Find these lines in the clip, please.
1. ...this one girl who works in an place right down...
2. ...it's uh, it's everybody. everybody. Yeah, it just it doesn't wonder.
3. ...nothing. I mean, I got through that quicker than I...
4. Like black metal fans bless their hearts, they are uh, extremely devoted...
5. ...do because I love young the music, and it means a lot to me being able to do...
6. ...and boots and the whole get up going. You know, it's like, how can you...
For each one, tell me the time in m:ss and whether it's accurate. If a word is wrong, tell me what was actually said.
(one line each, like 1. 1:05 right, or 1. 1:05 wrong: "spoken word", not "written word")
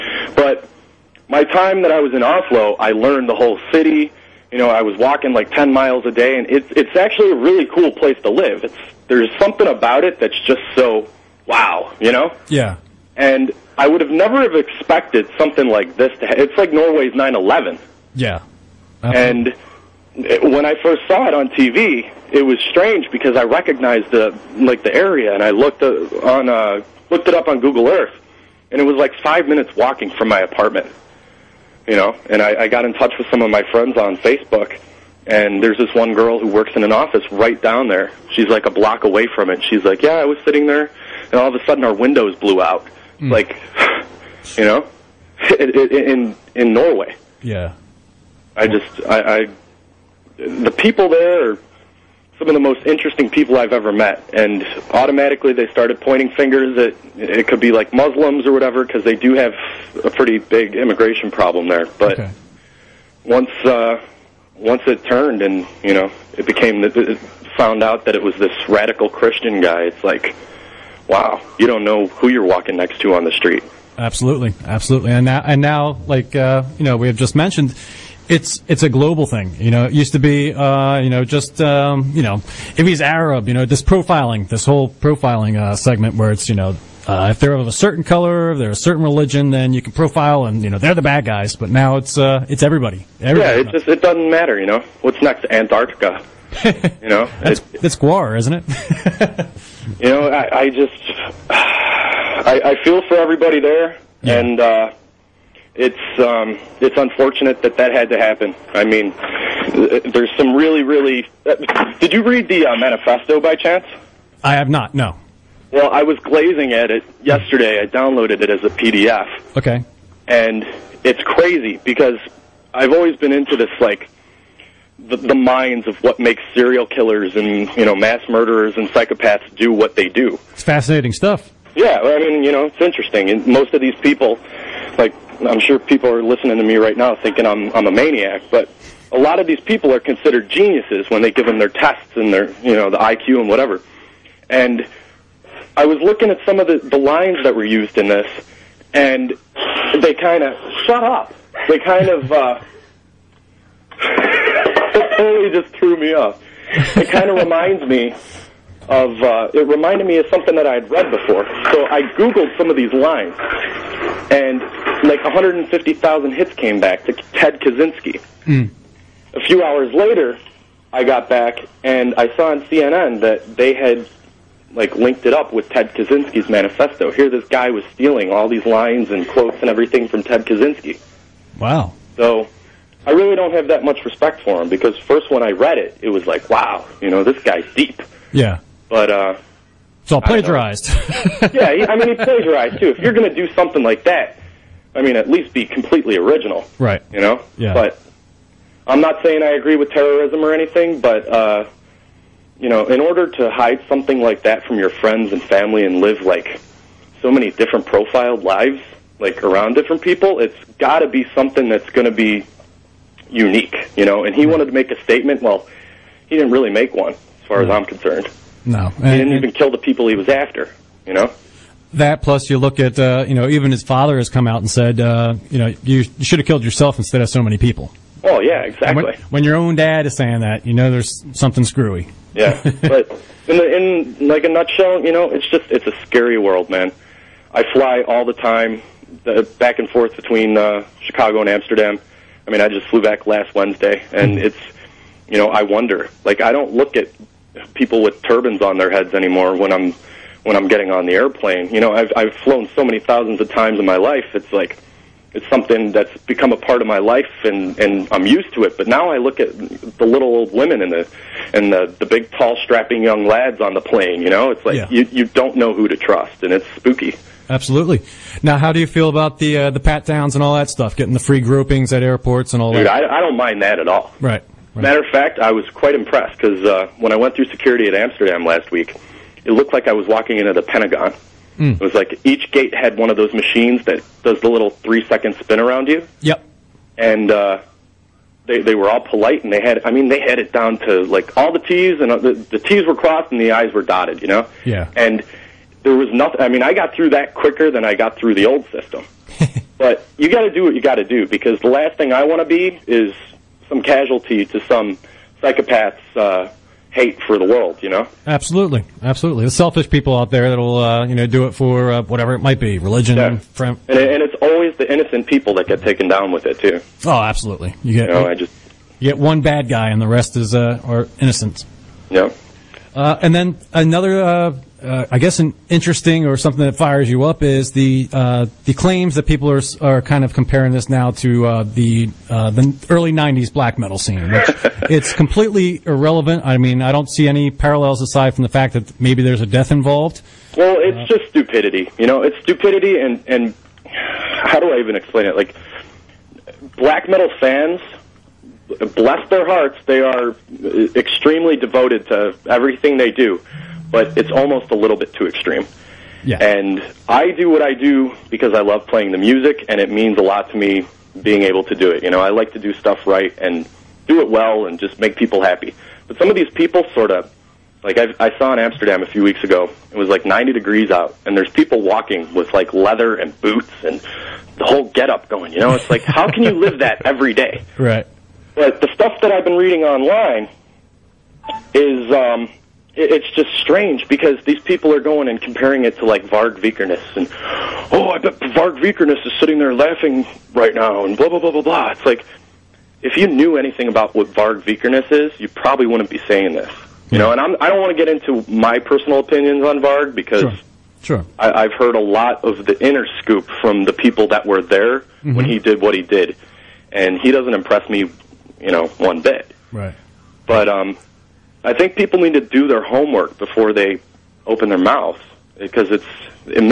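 1. 0:35 wrong: "office", not "place"
2. 1:31 wrong: "matter", not "wonder"
3. 4:56 right
4. 5:45 right
5. 5:57 wrong: "playing", not "young"
6. 6:13 right.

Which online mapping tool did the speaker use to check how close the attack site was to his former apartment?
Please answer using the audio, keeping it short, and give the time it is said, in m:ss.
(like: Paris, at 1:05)
Google Earth, at 0:27.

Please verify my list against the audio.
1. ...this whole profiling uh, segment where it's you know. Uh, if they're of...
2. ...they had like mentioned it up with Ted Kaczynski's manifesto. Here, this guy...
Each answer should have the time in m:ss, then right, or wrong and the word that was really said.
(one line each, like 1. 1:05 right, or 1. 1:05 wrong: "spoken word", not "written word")
1. 1:24 right
2. 2:53 wrong: "linked", not "mentioned".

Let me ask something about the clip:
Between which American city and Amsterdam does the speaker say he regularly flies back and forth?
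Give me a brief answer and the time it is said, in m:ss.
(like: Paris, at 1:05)
Chicago, at 4:00.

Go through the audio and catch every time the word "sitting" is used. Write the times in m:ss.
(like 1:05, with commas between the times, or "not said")
0:40, 6:29.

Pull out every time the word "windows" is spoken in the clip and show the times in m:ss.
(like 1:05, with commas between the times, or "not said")
0:41.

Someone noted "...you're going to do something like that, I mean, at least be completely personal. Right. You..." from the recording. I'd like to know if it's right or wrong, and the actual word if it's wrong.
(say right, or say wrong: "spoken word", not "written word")
wrong: "original", not "personal".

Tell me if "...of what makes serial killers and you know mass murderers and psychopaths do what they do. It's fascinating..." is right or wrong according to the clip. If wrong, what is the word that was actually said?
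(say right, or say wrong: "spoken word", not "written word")
right.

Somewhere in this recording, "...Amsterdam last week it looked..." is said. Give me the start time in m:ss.
4:37.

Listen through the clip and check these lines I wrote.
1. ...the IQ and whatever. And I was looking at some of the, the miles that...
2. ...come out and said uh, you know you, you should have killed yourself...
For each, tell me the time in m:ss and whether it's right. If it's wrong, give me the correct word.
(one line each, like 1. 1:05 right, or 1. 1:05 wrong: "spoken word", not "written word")
1. 2:22 wrong: "lines", not "miles"
2. 3:44 right.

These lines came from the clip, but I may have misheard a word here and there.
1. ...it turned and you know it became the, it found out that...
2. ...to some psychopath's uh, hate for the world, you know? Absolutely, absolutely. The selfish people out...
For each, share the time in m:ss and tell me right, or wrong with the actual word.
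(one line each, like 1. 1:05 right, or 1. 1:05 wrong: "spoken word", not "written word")
1. 1:04 right
2. 5:04 right.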